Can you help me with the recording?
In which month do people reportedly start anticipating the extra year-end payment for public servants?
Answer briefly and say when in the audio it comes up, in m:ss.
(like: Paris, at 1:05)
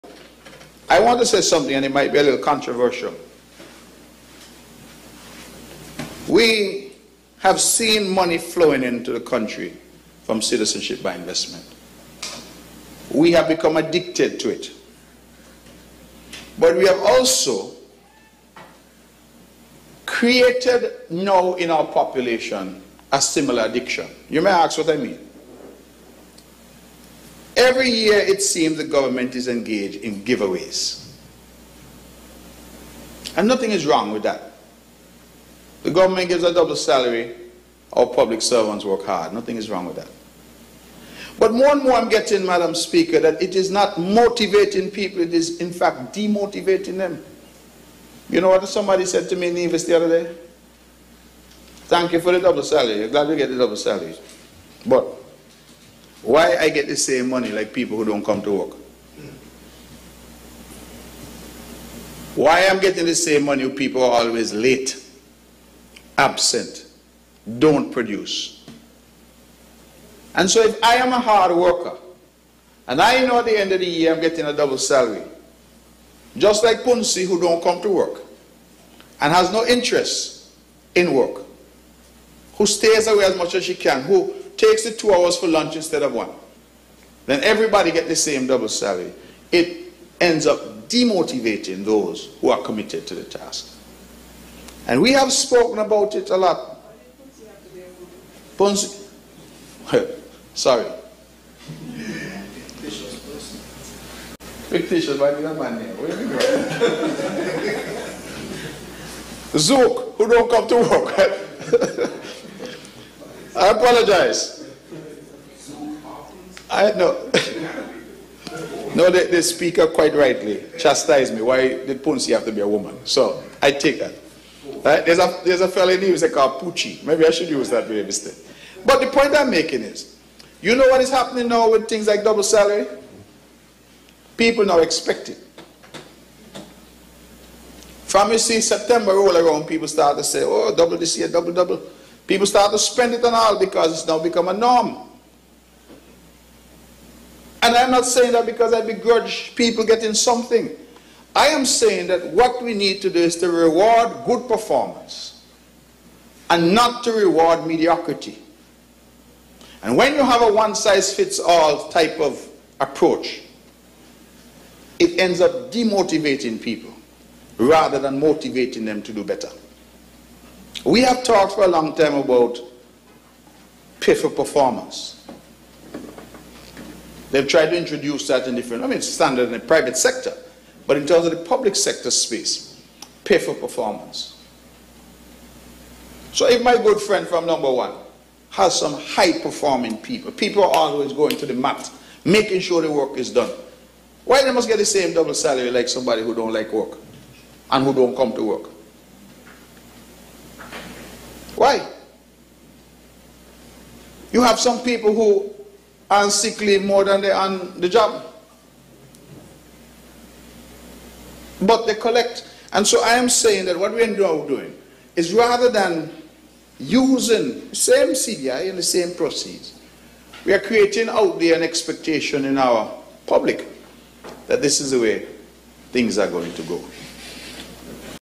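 September, at 2:18.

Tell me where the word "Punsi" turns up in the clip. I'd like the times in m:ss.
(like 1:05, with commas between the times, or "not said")
1:16.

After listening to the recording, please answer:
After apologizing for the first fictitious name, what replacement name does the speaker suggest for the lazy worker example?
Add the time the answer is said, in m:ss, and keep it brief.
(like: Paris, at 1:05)
Capucci, at 2:06.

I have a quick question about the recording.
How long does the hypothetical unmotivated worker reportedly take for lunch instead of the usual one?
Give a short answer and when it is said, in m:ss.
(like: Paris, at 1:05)
2 hours, at 1:24.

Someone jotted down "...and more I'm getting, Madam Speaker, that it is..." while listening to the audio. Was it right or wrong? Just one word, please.
right.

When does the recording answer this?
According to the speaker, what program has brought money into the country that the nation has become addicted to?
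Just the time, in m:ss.
0:10.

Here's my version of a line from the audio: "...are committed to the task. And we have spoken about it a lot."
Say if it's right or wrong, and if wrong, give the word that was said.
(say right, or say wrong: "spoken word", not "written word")
right.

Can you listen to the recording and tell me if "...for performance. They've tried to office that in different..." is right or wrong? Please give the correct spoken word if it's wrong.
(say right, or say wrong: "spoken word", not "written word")
wrong: "introduce", not "office".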